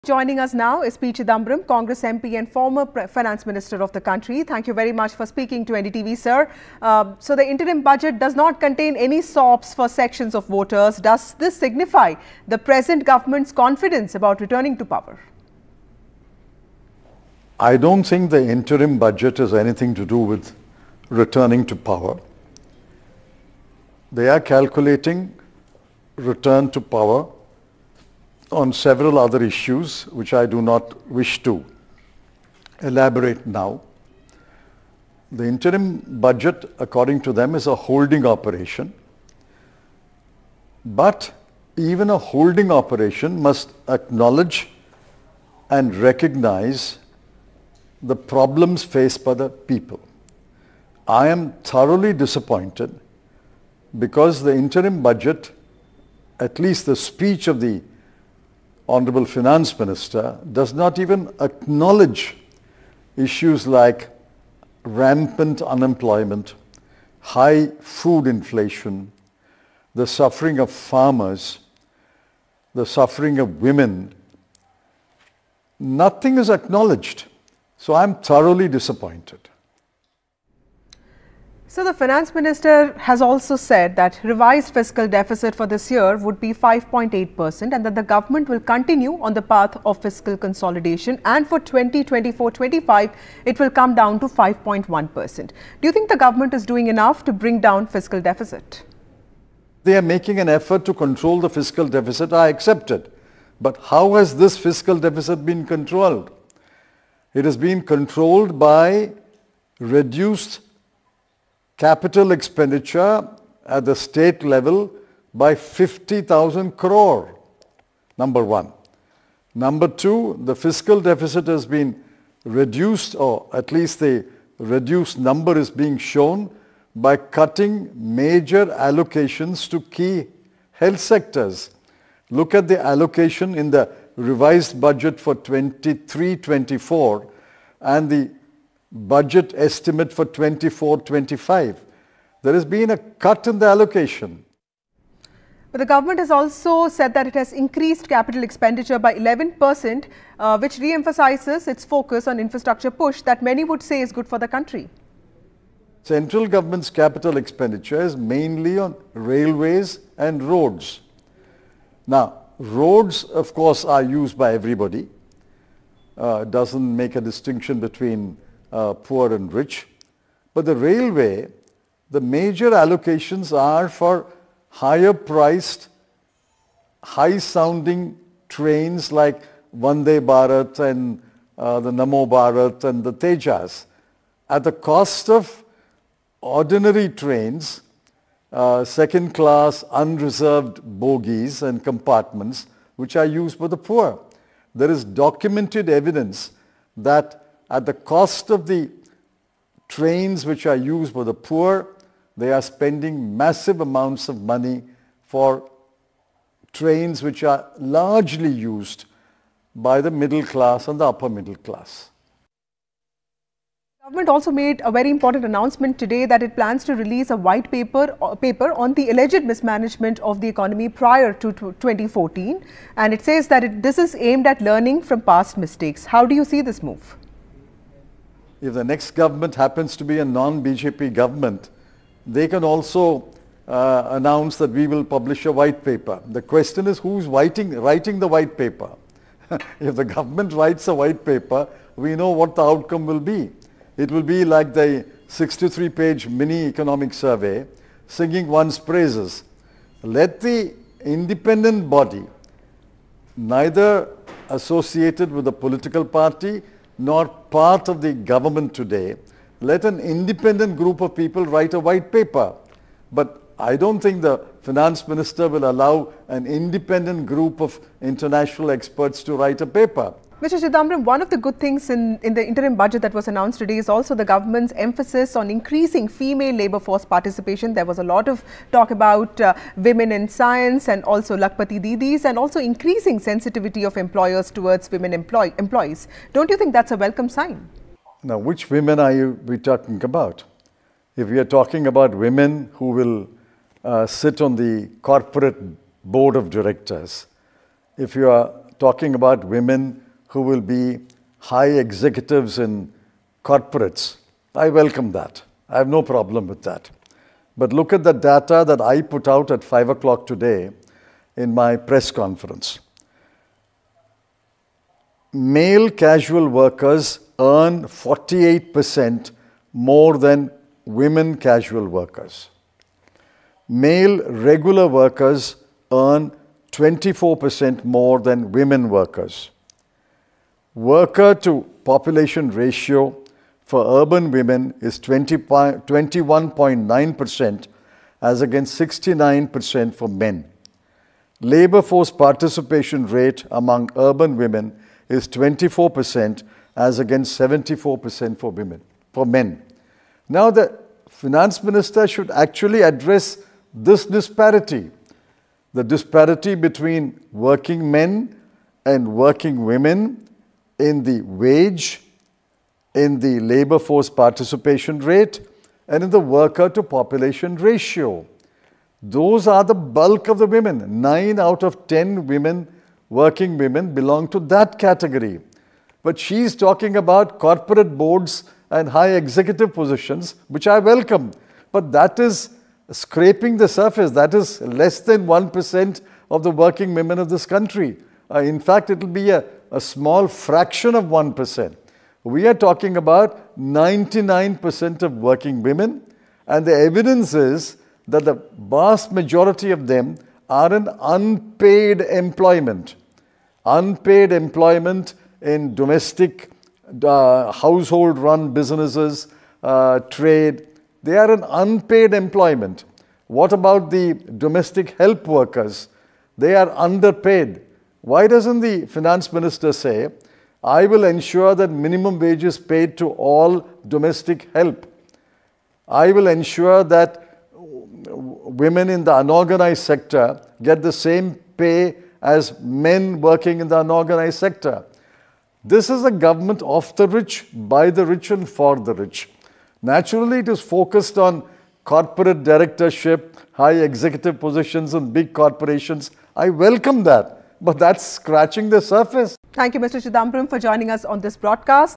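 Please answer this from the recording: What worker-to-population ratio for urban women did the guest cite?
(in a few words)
21.9%.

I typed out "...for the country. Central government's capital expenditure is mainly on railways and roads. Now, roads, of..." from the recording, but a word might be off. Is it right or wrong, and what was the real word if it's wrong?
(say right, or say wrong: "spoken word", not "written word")
right.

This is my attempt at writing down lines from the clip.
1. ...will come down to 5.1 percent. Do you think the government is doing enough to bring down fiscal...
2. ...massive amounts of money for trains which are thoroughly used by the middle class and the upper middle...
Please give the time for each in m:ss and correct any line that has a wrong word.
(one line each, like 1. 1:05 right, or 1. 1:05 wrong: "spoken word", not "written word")
1. 1:33 right
2. 3:23 wrong: "largely", not "thoroughly".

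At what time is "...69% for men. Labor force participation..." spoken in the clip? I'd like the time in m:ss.
5:38.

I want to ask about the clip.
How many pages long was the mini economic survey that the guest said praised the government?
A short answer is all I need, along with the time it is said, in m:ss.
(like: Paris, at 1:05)
63, at 4:05.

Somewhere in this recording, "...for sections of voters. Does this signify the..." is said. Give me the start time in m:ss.
0:09.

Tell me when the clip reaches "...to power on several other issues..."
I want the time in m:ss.
0:26.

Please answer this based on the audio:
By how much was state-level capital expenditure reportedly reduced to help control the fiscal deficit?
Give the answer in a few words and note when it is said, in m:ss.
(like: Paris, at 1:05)
50,000 crore, at 1:55.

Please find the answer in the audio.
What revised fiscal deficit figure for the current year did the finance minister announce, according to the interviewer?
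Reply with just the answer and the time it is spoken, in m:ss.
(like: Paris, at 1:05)
5.8 percent, at 1:26.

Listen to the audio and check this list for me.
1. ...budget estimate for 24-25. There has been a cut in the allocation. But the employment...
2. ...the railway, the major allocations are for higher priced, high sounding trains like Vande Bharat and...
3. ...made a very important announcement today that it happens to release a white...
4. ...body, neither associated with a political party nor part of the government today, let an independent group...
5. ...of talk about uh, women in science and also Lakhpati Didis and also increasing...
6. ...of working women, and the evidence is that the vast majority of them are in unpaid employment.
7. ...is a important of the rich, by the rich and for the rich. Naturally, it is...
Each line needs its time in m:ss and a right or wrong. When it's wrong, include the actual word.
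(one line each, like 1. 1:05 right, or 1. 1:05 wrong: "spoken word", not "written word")
1. 2:18 wrong: "government", not "employment"
2. 2:50 right
3. 3:34 wrong: "plans", not "happens"
4. 4:11 right
5. 4:38 right
6. 6:35 right
7. 7:15 wrong: "government", not "important".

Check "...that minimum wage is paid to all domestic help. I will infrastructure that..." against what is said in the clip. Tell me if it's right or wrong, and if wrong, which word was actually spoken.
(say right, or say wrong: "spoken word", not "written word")
wrong: "ensure", not "infrastructure".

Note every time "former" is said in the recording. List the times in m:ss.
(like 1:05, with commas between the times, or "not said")
0:02.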